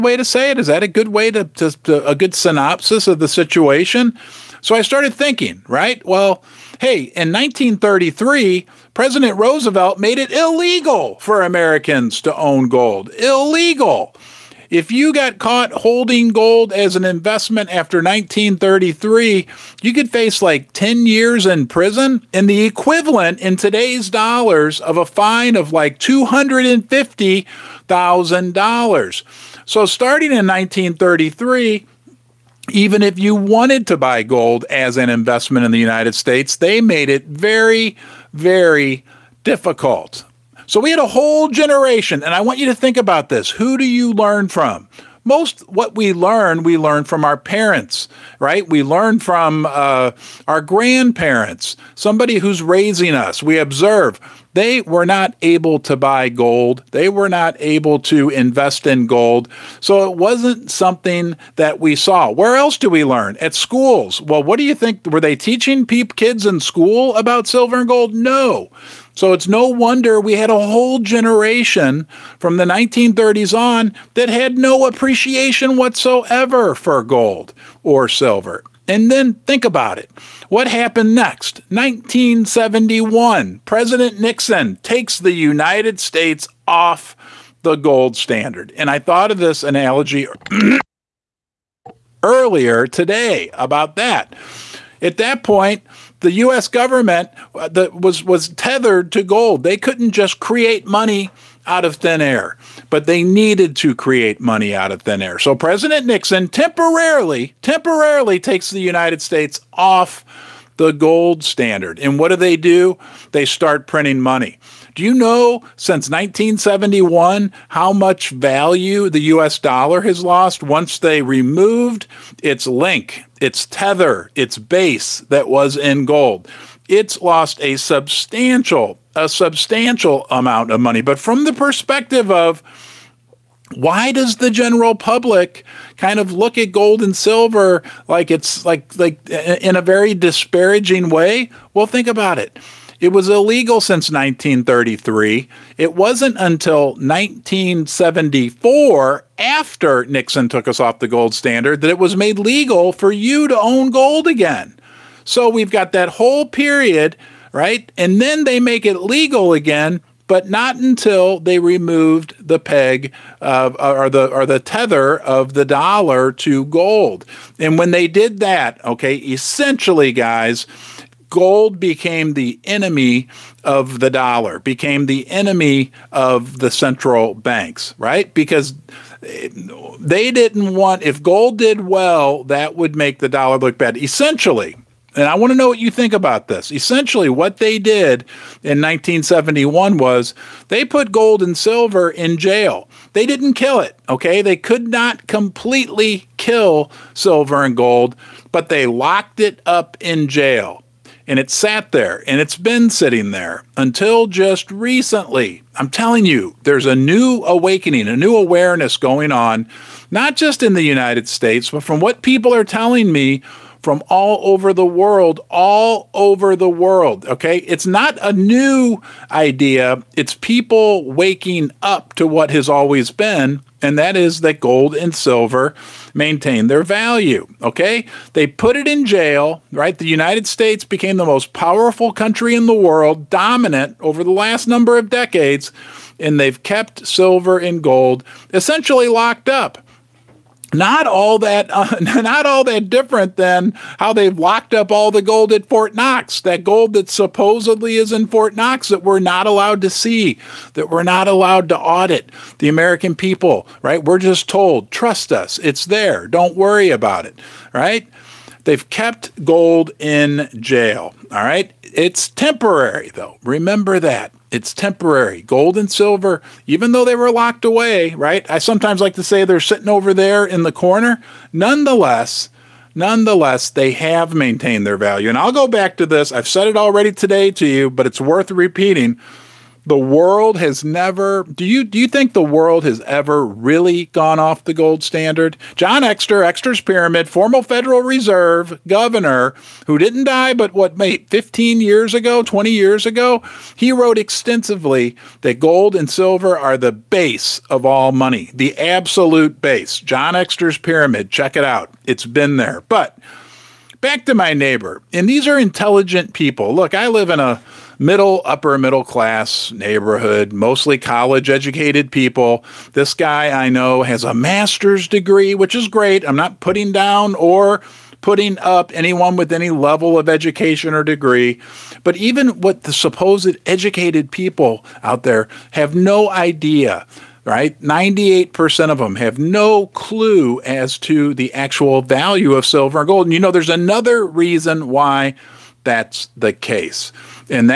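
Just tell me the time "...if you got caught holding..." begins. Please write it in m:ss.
0:14.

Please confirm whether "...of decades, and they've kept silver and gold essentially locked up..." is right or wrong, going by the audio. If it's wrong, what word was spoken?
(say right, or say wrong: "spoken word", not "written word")
right.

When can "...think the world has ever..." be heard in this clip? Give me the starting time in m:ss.
4:42.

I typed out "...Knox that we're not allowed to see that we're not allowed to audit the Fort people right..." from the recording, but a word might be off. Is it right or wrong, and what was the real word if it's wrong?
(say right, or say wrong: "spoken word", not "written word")
wrong: "American", not "Fort".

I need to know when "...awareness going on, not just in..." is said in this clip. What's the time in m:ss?
3:28.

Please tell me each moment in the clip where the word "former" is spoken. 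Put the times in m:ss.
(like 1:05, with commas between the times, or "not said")
4:47.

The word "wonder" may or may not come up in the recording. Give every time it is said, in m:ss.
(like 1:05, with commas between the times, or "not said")
1:09.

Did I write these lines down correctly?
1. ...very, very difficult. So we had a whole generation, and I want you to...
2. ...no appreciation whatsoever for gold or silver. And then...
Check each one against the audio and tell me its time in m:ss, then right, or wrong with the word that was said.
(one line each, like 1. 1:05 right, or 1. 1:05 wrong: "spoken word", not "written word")
1. 0:37 right
2. 1:14 right.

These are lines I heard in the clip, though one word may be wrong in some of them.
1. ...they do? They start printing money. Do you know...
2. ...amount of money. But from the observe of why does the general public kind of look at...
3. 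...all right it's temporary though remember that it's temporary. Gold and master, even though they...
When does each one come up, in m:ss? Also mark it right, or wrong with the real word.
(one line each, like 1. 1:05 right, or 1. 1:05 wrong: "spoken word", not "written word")
1. 1:52 right
2. 2:10 wrong: "perspective", not "observe"
3. 4:21 wrong: "silver", not "master".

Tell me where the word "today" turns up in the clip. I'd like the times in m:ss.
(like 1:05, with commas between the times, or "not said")
0:23, 1:32, 4:37.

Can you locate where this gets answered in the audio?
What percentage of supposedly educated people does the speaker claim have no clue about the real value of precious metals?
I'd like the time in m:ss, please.
5:27.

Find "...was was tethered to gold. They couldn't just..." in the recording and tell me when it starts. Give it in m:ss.
1:37.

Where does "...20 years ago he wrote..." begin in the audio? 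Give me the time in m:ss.
4:52.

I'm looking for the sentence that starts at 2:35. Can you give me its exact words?
So we've got that whole period, right?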